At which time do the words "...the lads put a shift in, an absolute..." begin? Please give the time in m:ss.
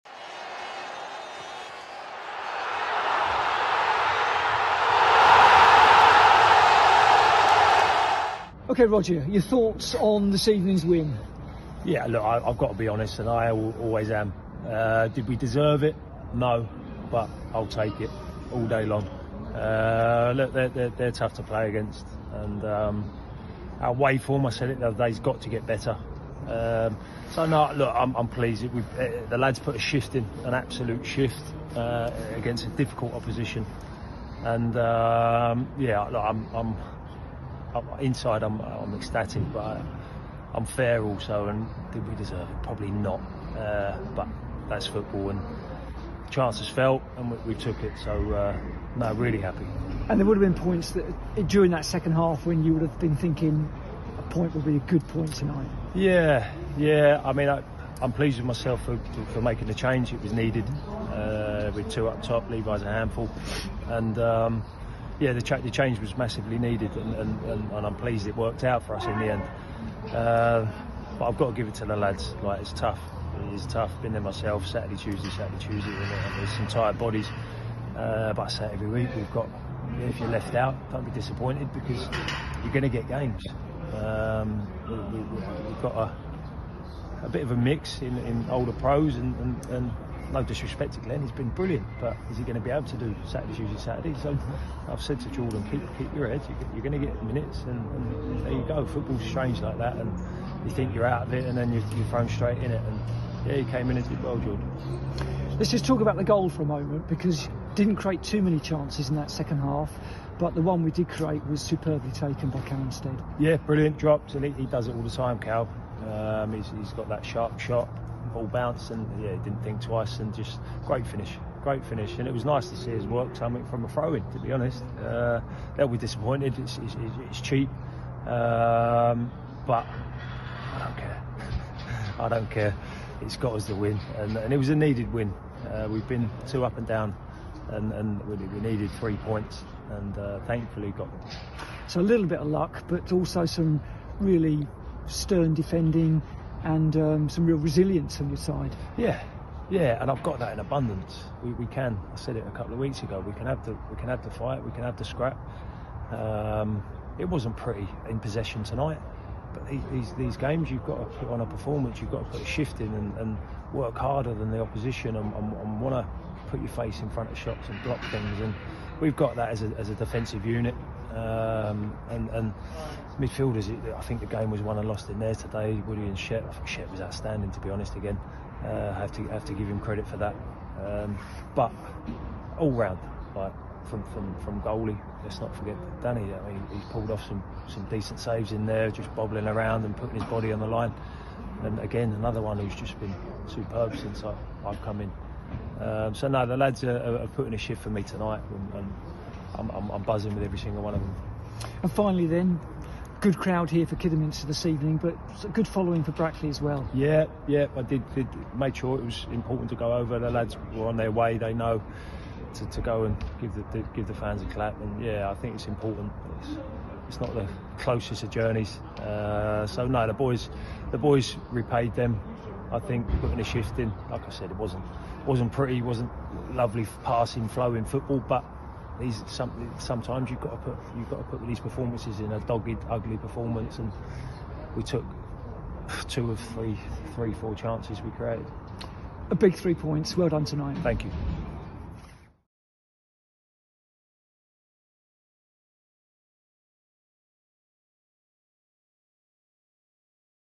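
0:29.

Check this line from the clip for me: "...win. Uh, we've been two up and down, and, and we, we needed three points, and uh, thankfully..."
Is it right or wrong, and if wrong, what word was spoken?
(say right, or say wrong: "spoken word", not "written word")
right.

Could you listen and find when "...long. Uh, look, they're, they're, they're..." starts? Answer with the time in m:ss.
0:18.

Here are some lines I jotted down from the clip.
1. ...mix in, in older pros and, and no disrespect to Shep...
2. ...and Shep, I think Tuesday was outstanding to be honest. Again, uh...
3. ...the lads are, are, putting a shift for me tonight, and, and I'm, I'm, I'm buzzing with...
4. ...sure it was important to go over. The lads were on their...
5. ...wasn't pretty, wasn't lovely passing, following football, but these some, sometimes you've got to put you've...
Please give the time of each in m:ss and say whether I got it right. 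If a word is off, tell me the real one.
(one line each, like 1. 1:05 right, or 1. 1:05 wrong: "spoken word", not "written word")
1. 1:27 wrong: "Glenn", not "Shep"
2. 2:56 wrong: "Shep", not "Tuesday"
3. 3:16 right
4. 3:28 right
5. 3:45 wrong: "flowing", not "following".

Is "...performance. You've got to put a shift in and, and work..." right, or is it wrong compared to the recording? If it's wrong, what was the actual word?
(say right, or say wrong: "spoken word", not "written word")
right.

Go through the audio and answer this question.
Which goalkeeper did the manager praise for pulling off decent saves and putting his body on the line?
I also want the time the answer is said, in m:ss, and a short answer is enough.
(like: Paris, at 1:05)
Danny, at 3:06.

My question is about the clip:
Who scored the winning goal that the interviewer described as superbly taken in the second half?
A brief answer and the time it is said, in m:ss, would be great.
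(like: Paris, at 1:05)
Callum Stead, at 1:52.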